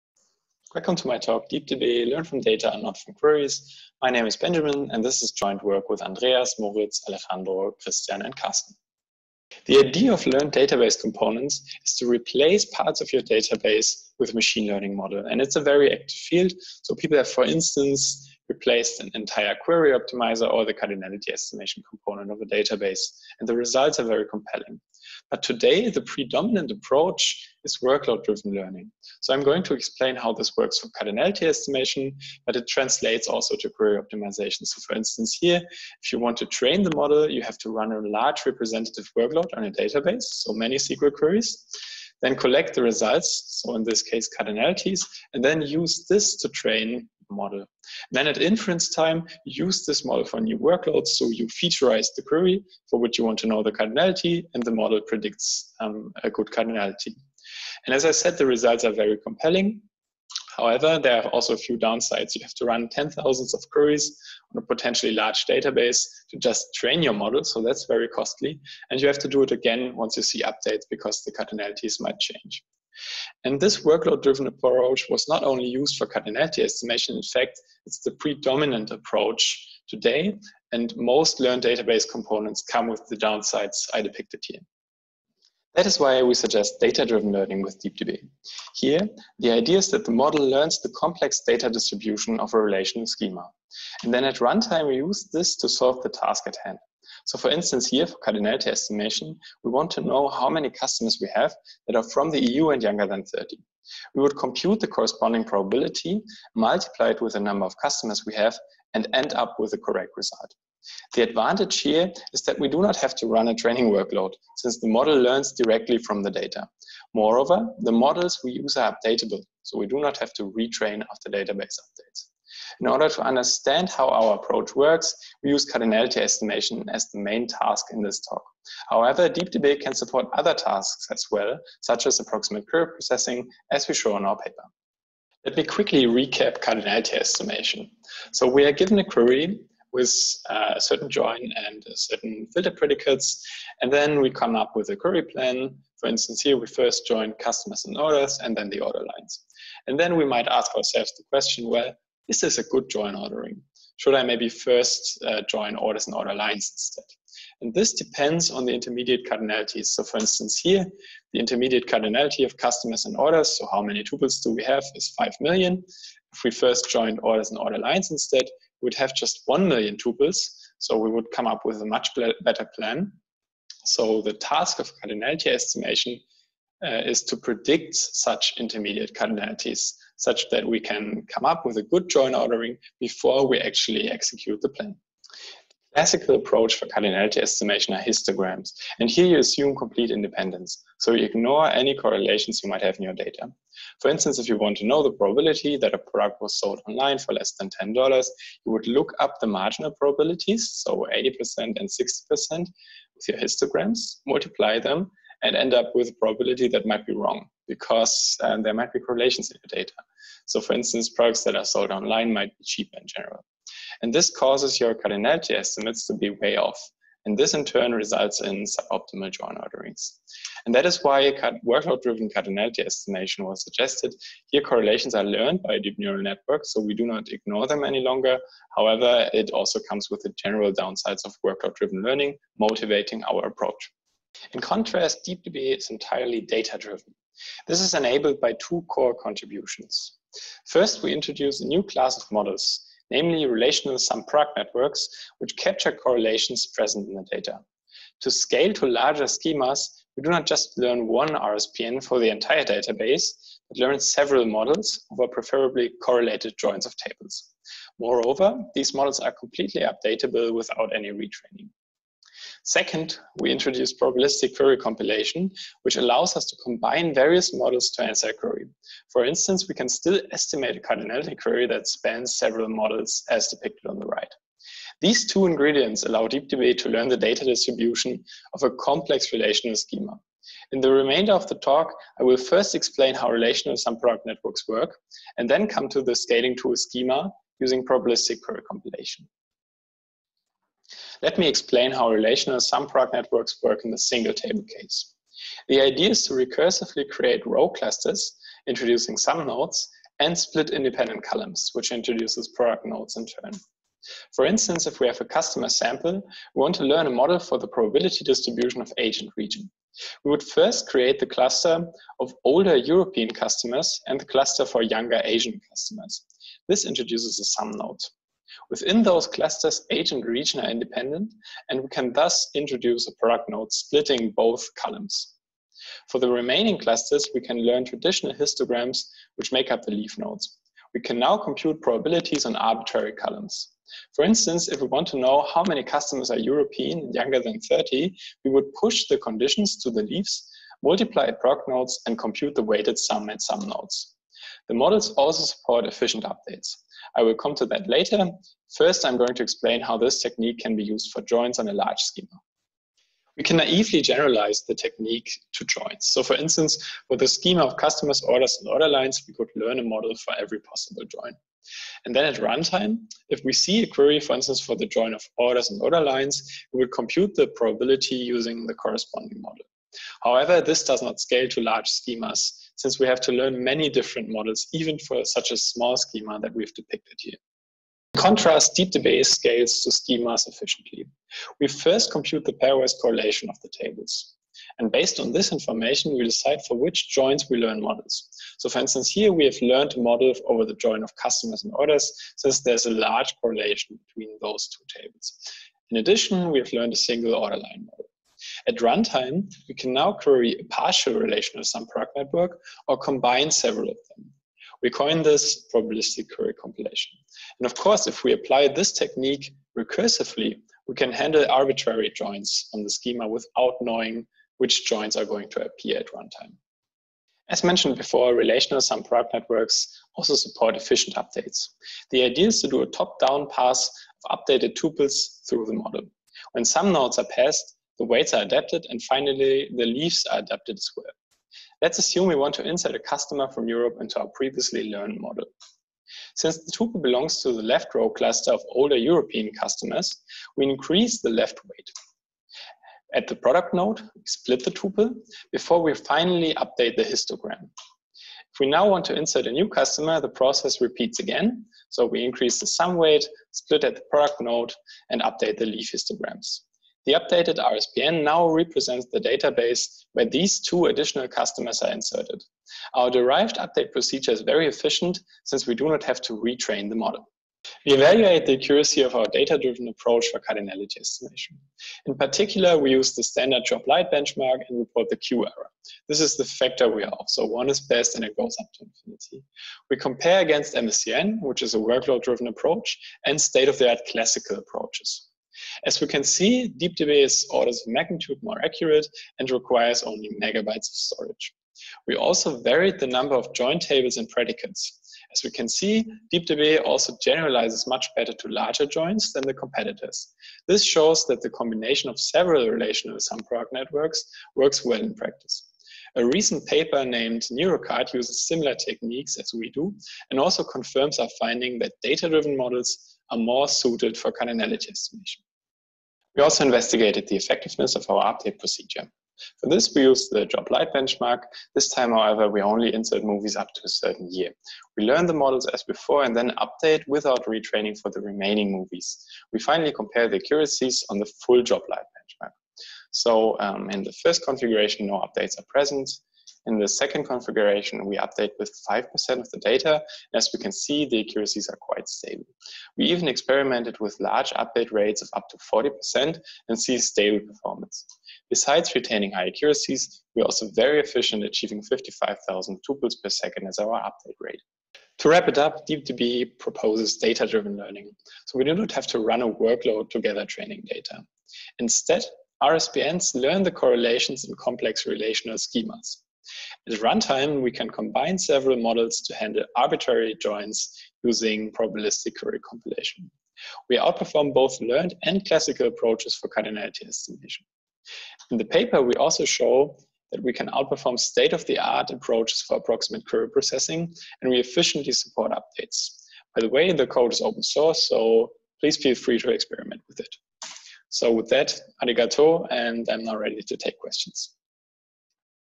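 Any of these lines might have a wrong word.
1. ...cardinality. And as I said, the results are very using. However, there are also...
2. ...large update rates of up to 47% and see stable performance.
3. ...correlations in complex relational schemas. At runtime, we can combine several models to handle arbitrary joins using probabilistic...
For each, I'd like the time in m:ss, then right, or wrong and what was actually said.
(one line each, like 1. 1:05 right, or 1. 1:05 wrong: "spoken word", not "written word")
1. 0:56 wrong: "compelling", not "using"
2. 9:04 wrong: "40", not "47"
3. 9:23 right.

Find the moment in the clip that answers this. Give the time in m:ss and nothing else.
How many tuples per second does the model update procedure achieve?
9:11.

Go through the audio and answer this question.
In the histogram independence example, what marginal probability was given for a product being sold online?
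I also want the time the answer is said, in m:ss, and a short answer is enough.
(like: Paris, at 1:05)
80%, at 3:21.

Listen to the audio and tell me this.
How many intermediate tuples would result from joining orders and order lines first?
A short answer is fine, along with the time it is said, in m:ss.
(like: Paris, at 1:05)
1 million, at 2:49.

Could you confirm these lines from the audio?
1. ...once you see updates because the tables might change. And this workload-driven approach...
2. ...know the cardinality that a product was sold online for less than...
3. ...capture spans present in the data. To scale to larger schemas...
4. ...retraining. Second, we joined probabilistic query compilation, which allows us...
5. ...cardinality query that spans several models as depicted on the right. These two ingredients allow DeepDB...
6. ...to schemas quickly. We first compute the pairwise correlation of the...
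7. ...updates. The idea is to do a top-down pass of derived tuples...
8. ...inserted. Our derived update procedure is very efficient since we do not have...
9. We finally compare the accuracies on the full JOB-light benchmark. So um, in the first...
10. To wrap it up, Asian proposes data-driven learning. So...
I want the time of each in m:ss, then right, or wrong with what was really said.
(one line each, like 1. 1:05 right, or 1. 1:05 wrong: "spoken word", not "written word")
1. 1:09 wrong: "cardinalities", not "tables"
2. 3:14 wrong: "probability", not "cardinality"
3. 4:05 wrong: "correlations", not "spans"
4. 4:21 wrong: "introduced", not "joined"
5. 4:30 right
6. 6:19 wrong: "efficiently", not "quickly"
7. 7:01 wrong: "updated", not "derived"
8. 7:41 right
9. 8:49 right
10. 9:15 wrong: "DeepDB", not "Asian".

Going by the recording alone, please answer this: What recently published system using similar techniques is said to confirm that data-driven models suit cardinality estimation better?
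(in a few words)
Neurocard.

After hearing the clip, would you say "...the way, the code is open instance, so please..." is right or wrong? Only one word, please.
wrong.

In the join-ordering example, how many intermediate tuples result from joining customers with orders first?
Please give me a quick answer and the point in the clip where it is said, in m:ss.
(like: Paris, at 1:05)
5 million, at 2:45.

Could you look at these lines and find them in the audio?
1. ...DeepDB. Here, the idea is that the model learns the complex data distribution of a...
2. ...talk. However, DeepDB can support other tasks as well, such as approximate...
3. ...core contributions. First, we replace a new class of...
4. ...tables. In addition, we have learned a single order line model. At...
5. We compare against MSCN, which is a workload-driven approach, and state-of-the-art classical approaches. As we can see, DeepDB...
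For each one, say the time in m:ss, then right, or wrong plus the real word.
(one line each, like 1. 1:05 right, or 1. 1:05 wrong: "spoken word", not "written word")
1. 1:27 right
2. 2:08 right
3. 3:58 wrong: "introduce", not "replace"
4. 6:35 right
5. 7:59 right.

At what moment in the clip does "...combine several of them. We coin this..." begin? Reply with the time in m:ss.
6:42.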